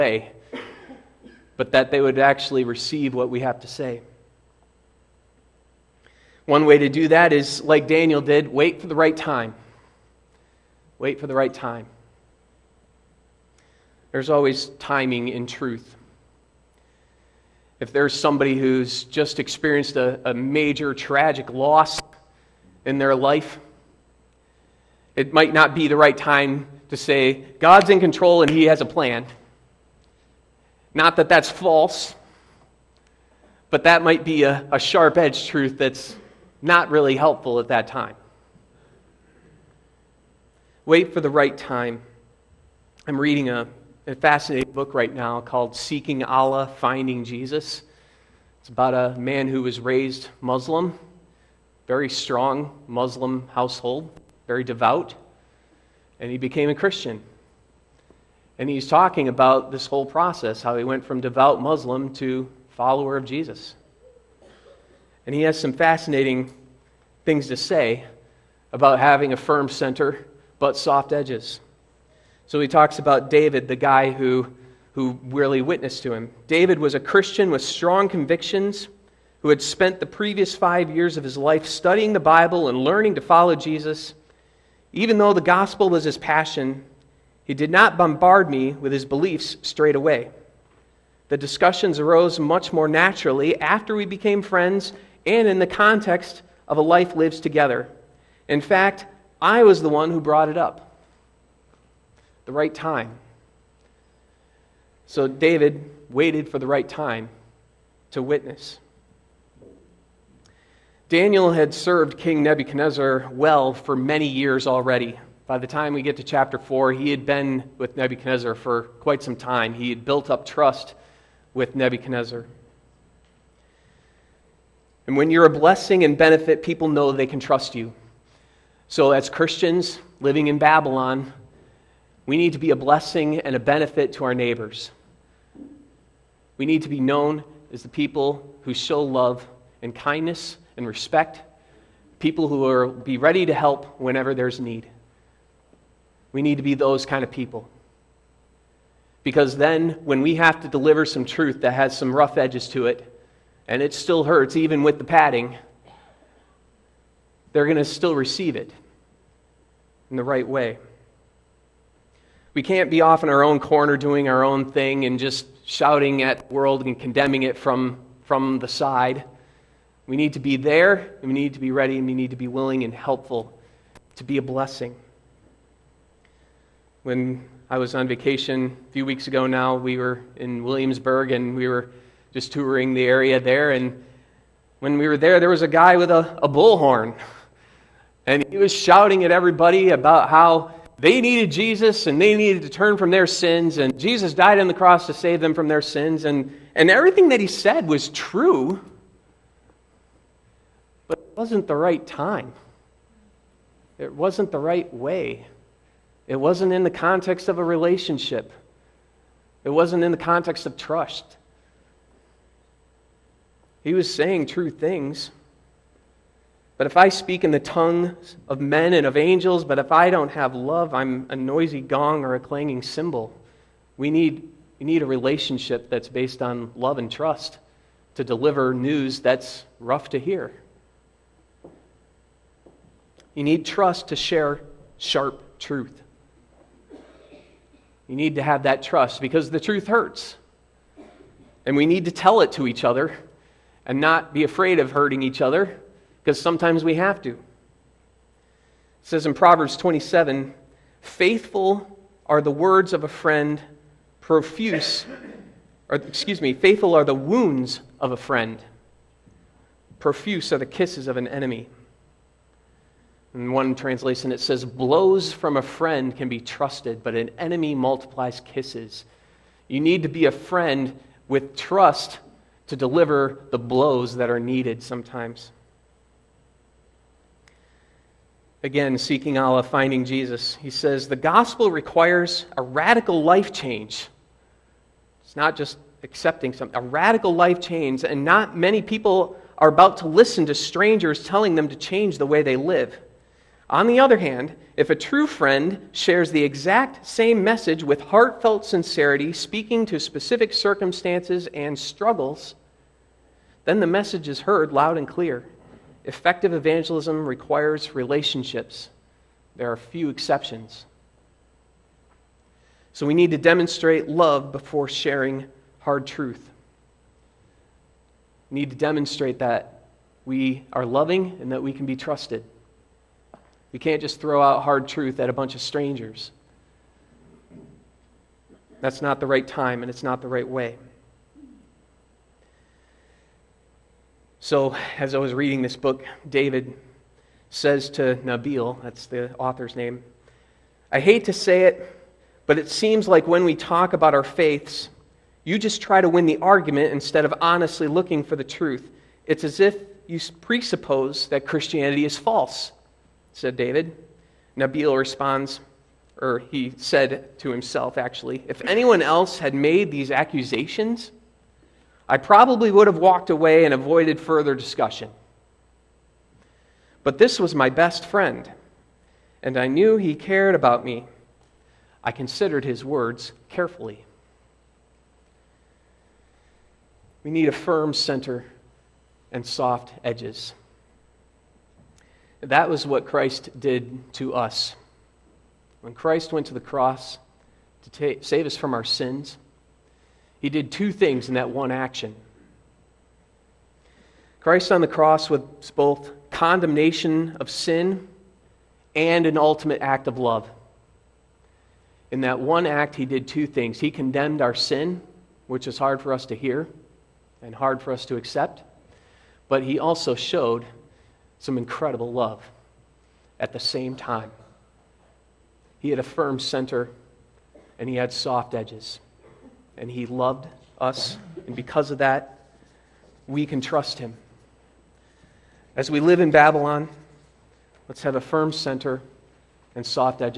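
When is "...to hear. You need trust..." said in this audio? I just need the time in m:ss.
3:50.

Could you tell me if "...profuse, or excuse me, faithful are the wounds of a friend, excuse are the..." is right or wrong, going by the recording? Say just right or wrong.
wrong.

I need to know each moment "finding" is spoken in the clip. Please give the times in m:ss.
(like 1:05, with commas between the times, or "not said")
0:46, 4:39.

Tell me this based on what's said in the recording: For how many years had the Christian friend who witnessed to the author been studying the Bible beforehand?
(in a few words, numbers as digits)
5.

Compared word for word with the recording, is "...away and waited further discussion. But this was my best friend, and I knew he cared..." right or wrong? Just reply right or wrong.
wrong.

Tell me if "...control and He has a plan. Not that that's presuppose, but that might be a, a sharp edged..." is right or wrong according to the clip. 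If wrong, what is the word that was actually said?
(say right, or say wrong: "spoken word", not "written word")
wrong: "false", not "presuppose".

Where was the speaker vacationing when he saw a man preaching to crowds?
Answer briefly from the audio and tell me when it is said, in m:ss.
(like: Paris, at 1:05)
Williamsburg, at 3:00.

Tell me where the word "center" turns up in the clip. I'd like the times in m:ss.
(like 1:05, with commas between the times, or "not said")
1:09, 6:17, 6:56, 7:08.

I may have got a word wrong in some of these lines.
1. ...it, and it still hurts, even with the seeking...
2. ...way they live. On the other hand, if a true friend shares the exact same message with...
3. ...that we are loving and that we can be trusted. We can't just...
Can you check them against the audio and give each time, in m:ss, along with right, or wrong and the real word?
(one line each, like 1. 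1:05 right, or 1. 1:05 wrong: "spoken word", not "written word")
1. 2:32 wrong: "padding", not "seeking"
2. 4:52 right
3. 5:19 right.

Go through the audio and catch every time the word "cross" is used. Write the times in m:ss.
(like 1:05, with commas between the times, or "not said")
3:14, 6:26, 6:34.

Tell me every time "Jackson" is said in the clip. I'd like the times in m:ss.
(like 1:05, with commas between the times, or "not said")
not said.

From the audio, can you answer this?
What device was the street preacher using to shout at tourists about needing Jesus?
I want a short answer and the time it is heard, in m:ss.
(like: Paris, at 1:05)
A bullhorn, at 3:06.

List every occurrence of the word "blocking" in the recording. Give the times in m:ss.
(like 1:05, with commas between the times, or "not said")
not said.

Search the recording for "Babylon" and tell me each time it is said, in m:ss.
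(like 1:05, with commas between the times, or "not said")
2:10, 7:06.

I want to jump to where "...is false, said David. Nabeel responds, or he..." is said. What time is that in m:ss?
5:52.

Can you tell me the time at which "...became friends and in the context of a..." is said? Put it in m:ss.
1:34.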